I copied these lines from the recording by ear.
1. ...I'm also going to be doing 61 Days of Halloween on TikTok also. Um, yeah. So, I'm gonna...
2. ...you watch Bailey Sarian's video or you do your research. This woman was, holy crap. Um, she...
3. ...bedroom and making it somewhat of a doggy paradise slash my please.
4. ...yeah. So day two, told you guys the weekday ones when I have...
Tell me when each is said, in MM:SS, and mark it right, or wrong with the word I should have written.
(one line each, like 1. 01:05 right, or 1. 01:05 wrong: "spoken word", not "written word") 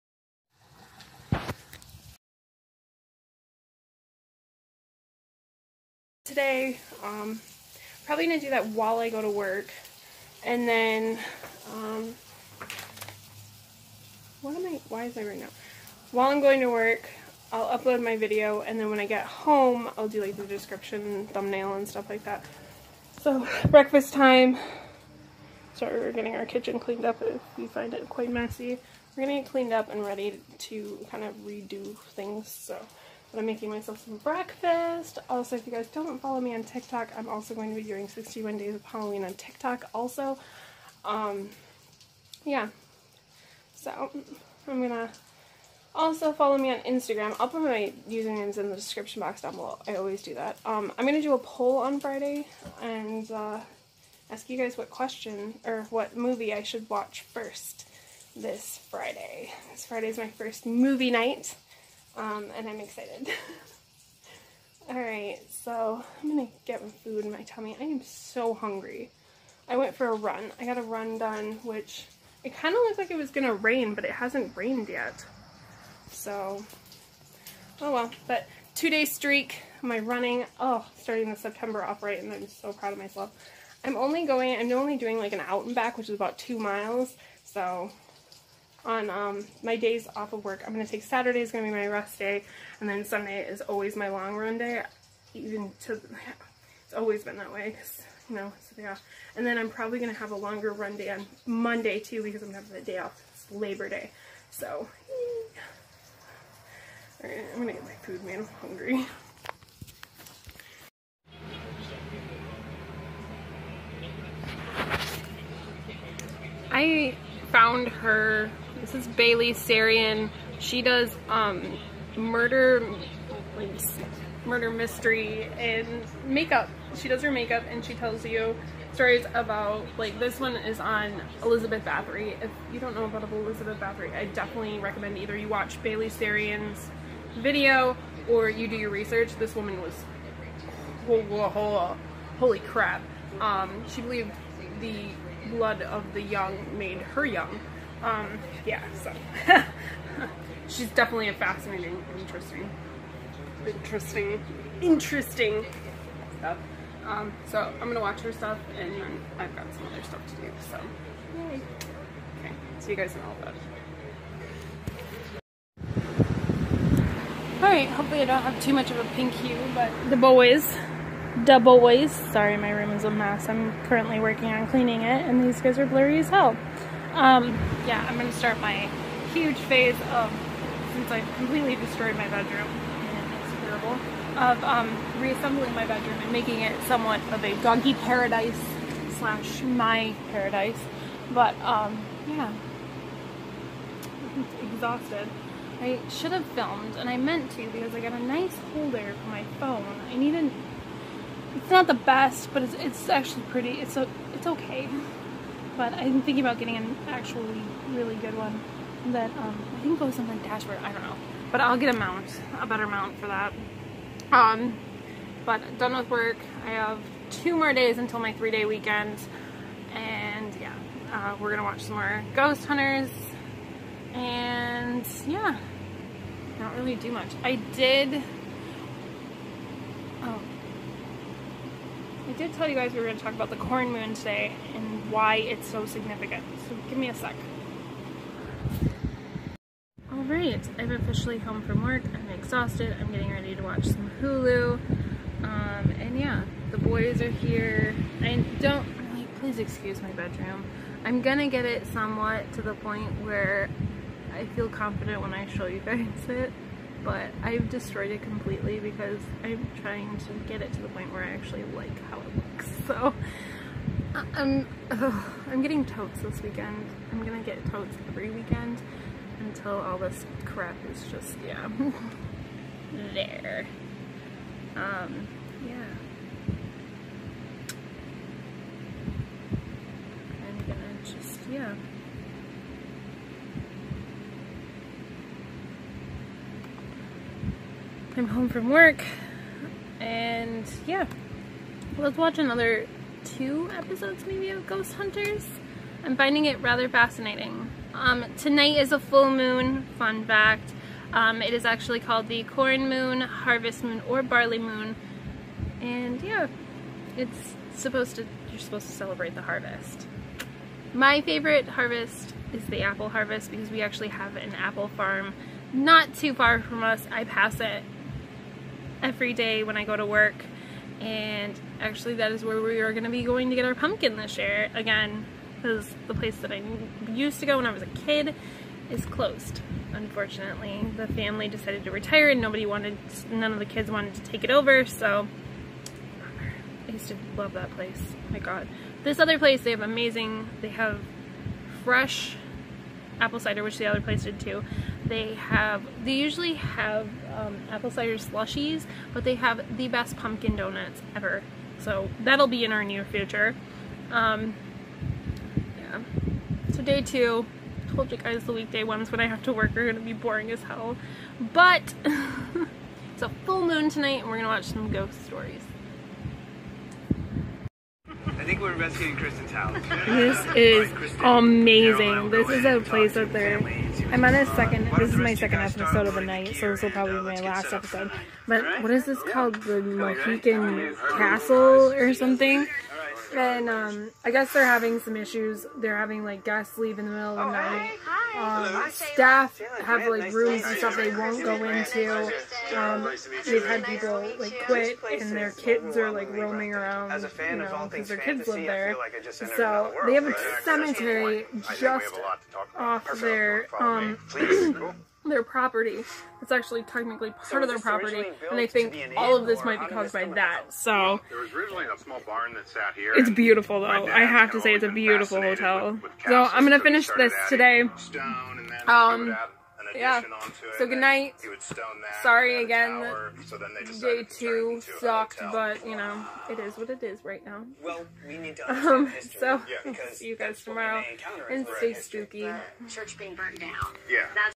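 1. 00:37 right
2. 02:15 right
3. 03:05 wrong: "paradise", not "please"
4. 05:55 right.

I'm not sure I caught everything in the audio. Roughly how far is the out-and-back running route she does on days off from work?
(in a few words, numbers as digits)
2 miles.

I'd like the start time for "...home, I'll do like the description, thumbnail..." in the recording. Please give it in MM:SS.
00:19.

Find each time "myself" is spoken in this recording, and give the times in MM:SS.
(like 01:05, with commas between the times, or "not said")
00:33, 01:22.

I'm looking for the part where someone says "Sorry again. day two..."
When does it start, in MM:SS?
07:02.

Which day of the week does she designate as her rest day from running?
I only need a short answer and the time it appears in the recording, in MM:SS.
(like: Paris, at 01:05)
Saturday, at 01:31.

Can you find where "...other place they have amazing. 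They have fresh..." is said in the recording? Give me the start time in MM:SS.
05:39.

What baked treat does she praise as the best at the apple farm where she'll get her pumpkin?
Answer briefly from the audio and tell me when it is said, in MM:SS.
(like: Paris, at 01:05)
pumpkin donuts, at 05:50.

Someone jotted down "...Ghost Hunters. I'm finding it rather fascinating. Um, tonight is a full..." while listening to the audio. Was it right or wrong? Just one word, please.
right.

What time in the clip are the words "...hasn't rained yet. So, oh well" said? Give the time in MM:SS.
01:14.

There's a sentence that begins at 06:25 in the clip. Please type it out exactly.
They're having like guests leave in the middle of the oh, night.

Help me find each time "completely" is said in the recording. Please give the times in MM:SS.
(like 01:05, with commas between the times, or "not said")
03:01, 04:18.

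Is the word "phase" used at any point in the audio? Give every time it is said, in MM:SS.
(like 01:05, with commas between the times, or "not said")
02:59.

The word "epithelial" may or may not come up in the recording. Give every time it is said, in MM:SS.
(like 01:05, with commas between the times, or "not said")
not said.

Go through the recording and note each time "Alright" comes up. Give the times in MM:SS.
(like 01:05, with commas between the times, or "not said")
01:04, 01:47, 02:47, 04:00.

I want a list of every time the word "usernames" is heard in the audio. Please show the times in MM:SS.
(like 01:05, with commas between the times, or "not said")
00:48.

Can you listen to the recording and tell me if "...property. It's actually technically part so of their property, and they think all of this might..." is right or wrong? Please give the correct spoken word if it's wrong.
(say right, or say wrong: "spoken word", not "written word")
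right.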